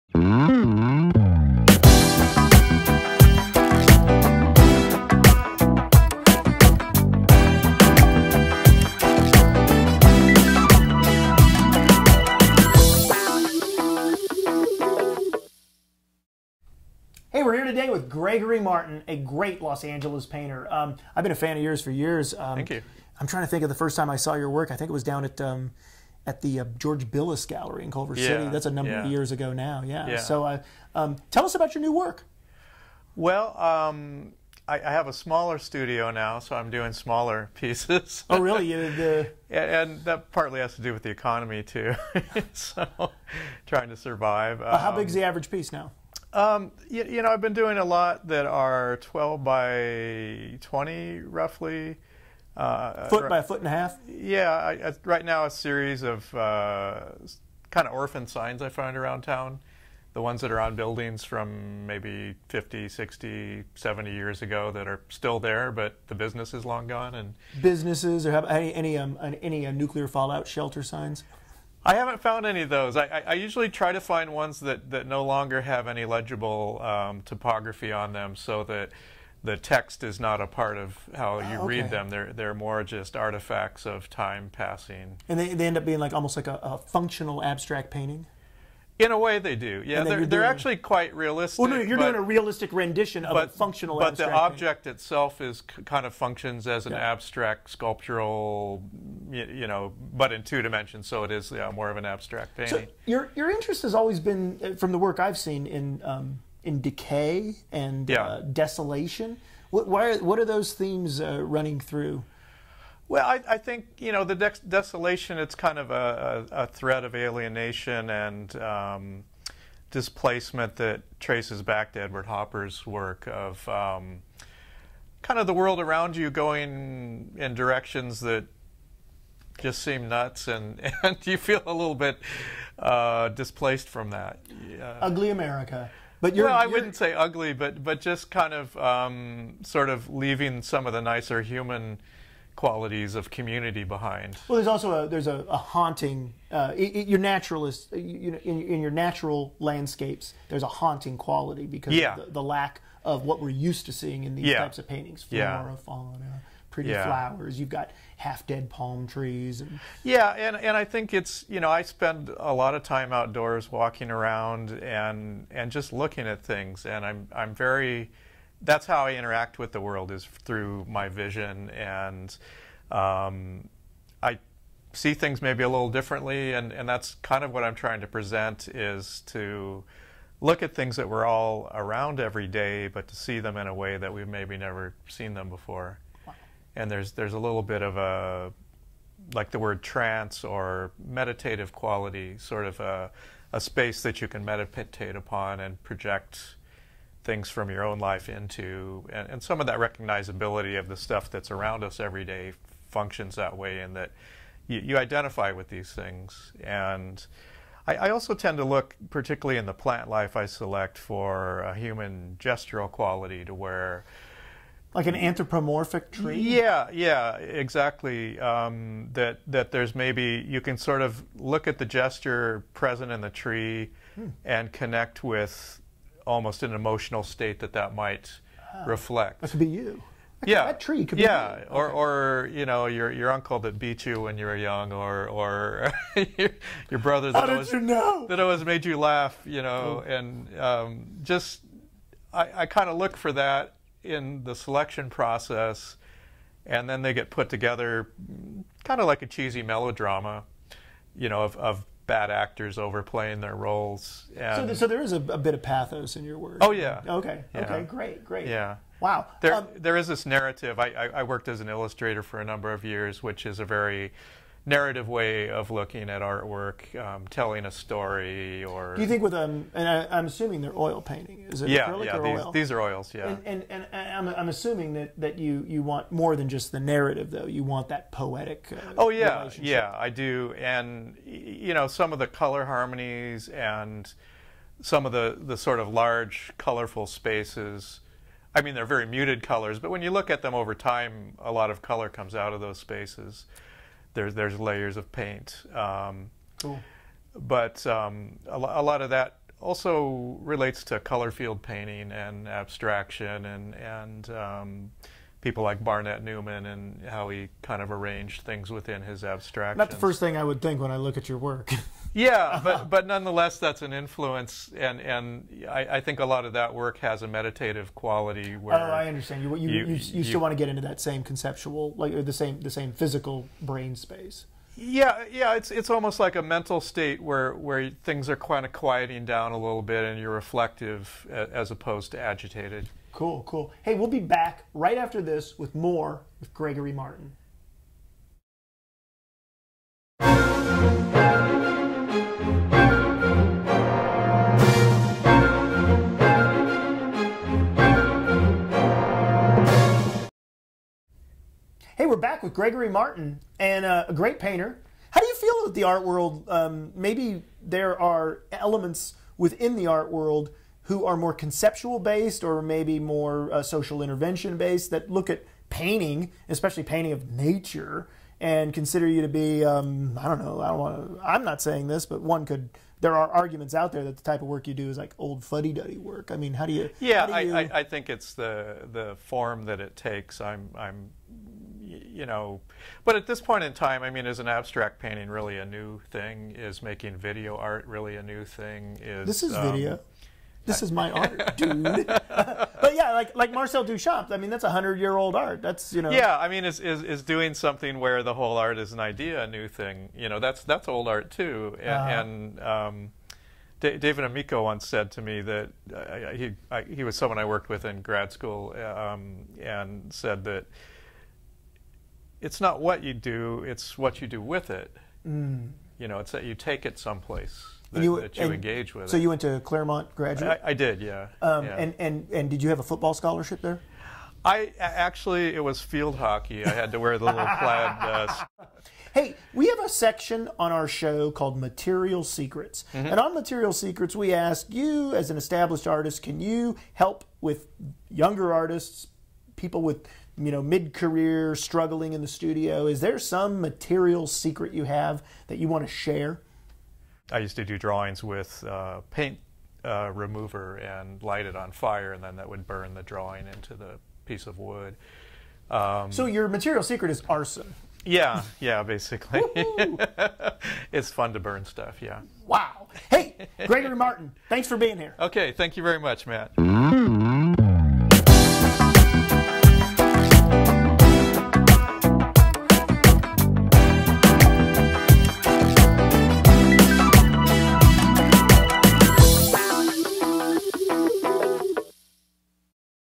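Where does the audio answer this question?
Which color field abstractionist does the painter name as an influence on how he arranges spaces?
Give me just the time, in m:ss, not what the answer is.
5:05.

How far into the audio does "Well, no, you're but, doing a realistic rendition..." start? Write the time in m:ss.
1:31.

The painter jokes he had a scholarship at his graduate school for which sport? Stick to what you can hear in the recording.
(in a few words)
Field hockey.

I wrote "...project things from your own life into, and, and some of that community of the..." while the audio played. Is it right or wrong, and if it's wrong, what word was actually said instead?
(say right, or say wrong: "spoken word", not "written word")
wrong: "recognizability", not "community".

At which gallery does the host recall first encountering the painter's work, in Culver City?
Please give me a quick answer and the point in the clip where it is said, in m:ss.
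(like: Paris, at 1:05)
George Billis Gallery, at 0:26.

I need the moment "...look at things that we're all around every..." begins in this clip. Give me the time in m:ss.
3:00.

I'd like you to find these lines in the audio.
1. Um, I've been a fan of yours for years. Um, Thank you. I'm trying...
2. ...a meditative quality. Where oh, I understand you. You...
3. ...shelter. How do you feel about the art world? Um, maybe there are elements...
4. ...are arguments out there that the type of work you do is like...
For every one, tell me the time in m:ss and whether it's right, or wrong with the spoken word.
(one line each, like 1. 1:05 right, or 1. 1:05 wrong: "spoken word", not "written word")
1. 0:20 right
2. 5:17 right
3. 5:54 wrong: "painter", not "shelter"
4. 6:13 right.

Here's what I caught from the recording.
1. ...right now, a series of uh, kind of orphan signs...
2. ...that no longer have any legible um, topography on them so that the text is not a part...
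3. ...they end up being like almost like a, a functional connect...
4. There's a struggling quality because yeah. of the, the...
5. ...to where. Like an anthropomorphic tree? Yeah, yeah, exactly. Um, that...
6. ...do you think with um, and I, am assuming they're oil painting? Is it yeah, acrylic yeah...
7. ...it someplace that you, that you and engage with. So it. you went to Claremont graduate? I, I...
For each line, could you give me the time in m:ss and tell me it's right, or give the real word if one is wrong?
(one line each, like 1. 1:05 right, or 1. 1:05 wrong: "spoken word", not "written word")
1. 0:55 right
2. 1:14 right
3. 1:25 wrong: "abstract", not "connect"
4. 2:30 wrong: "haunting", not "struggling"
5. 3:33 right
6. 4:28 right
7. 6:56 right.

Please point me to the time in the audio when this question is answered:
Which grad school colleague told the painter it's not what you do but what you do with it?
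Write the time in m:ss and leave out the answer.
6:43.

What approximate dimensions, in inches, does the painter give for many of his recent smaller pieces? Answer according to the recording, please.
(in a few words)
12 by 20.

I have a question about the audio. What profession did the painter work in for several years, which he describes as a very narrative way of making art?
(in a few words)
Illustrator.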